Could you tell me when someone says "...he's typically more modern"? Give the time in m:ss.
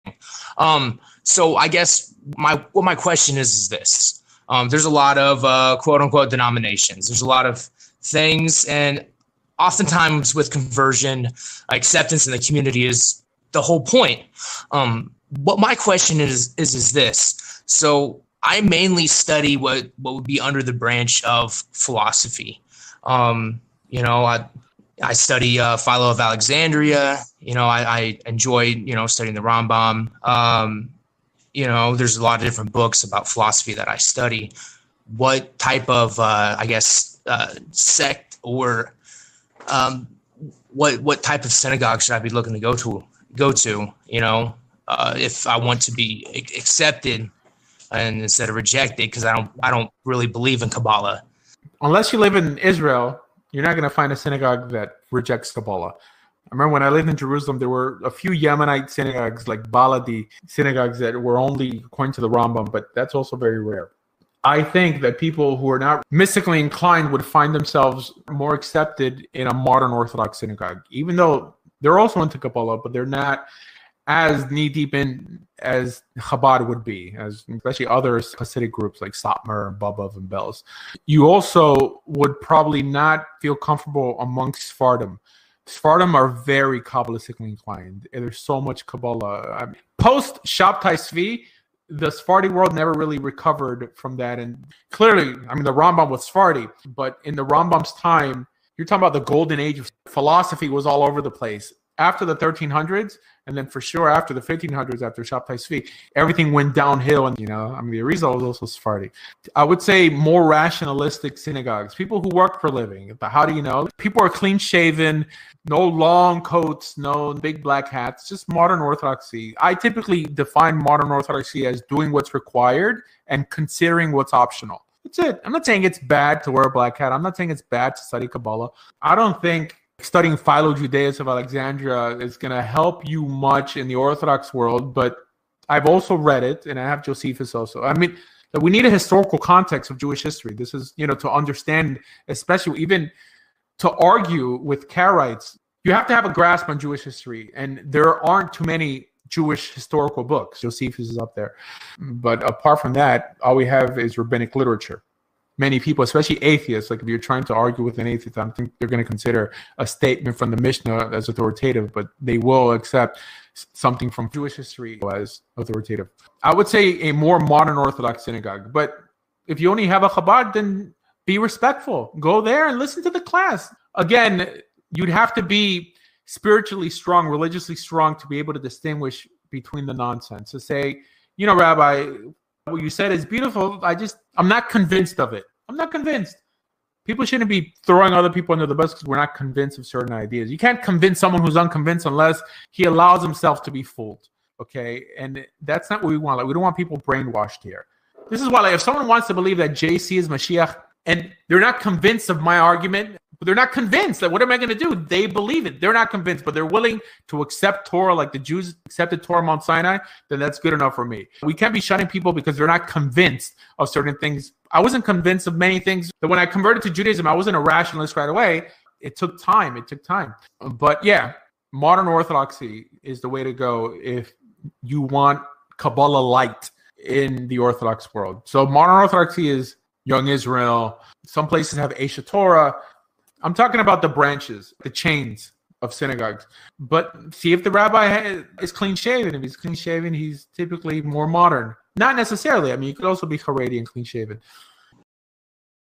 4:00.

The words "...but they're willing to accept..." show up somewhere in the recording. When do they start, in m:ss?
3:26.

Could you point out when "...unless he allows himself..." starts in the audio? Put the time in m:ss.
3:12.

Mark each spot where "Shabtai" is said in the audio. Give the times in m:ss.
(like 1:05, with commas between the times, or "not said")
1:30, 1:45.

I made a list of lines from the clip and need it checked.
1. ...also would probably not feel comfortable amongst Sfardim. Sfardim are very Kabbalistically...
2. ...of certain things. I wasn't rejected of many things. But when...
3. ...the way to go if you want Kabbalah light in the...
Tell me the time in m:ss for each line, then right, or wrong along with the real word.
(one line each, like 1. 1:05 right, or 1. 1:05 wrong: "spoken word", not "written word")
1. 1:21 right
2. 3:33 wrong: "convinced", not "rejected"
3. 3:43 right.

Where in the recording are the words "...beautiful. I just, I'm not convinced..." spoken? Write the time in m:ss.
3:03.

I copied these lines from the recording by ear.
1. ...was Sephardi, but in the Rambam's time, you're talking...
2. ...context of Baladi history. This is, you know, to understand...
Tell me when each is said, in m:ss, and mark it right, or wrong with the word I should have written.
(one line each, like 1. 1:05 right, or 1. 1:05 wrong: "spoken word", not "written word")
1. 1:36 right
2. 2:19 wrong: "Jewish", not "Baladi".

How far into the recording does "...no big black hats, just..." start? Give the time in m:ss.
1:56.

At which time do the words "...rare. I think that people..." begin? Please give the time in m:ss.
1:03.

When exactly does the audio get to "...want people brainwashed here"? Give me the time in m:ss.
3:16.